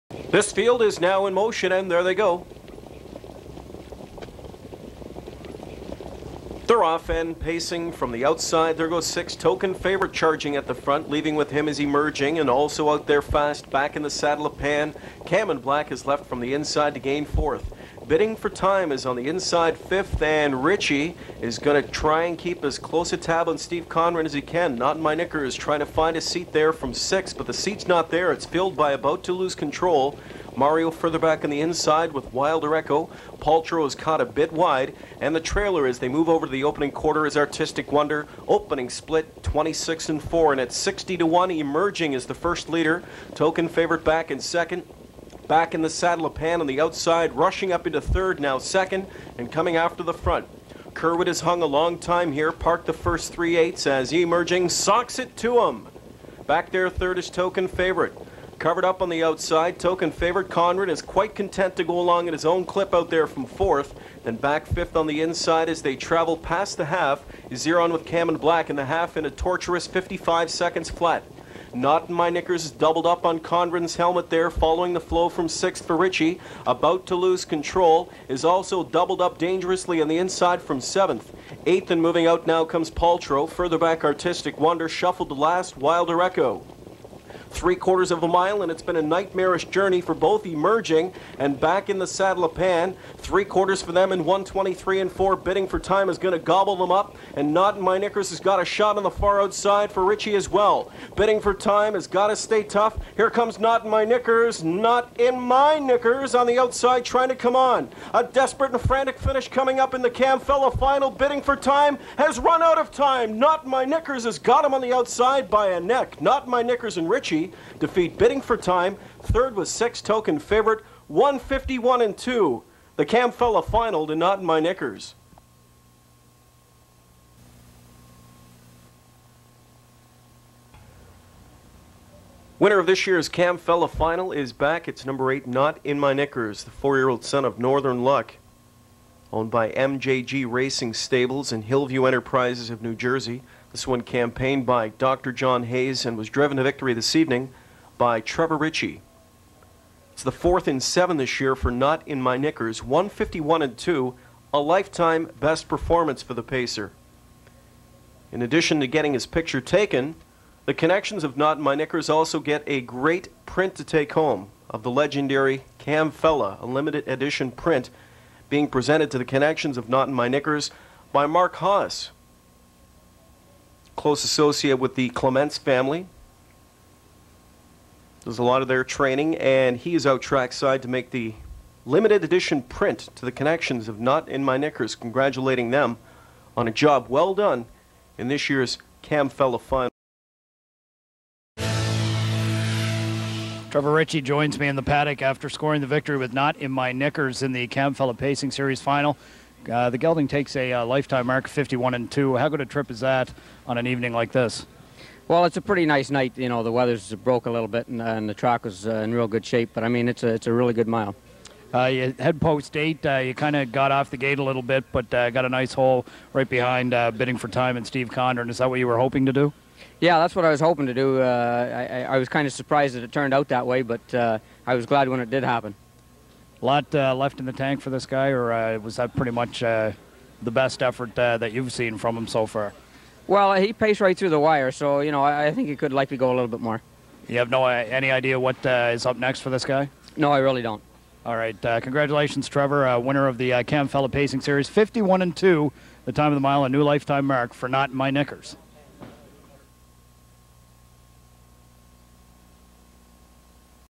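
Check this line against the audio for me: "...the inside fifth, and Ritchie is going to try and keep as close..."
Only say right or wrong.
right.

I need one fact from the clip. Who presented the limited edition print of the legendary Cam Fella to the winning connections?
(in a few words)
Mark Haas.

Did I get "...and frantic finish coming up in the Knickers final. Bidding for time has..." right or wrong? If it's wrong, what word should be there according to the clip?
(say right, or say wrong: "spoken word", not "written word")
wrong: "Camfella", not "Knickers".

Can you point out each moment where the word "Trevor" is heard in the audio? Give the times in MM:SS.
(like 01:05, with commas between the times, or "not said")
02:28, 03:13, 04:02.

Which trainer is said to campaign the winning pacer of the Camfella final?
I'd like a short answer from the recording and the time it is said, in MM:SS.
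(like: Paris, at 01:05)
Dr. John Hayes, at 02:24.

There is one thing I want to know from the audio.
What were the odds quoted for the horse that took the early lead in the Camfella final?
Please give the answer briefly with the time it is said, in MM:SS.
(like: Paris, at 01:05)
60 to 1, at 00:40.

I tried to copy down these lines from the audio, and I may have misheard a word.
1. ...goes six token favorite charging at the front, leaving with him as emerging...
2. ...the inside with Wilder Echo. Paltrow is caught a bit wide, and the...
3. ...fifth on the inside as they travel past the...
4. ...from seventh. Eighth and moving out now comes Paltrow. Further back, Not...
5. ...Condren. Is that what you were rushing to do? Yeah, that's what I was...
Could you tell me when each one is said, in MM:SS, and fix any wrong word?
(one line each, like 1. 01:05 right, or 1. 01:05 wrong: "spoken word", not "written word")
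1. 00:08 right
2. 00:31 right
3. 01:04 right
4. 01:20 wrong: "Artistic", not "Not"
5. 03:38 wrong: "hoping", not "rushing".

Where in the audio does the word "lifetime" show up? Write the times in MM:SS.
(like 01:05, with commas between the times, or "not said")
02:34, 03:20, 04:06.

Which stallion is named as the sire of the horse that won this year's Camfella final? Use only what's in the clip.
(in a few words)
Northern Luck.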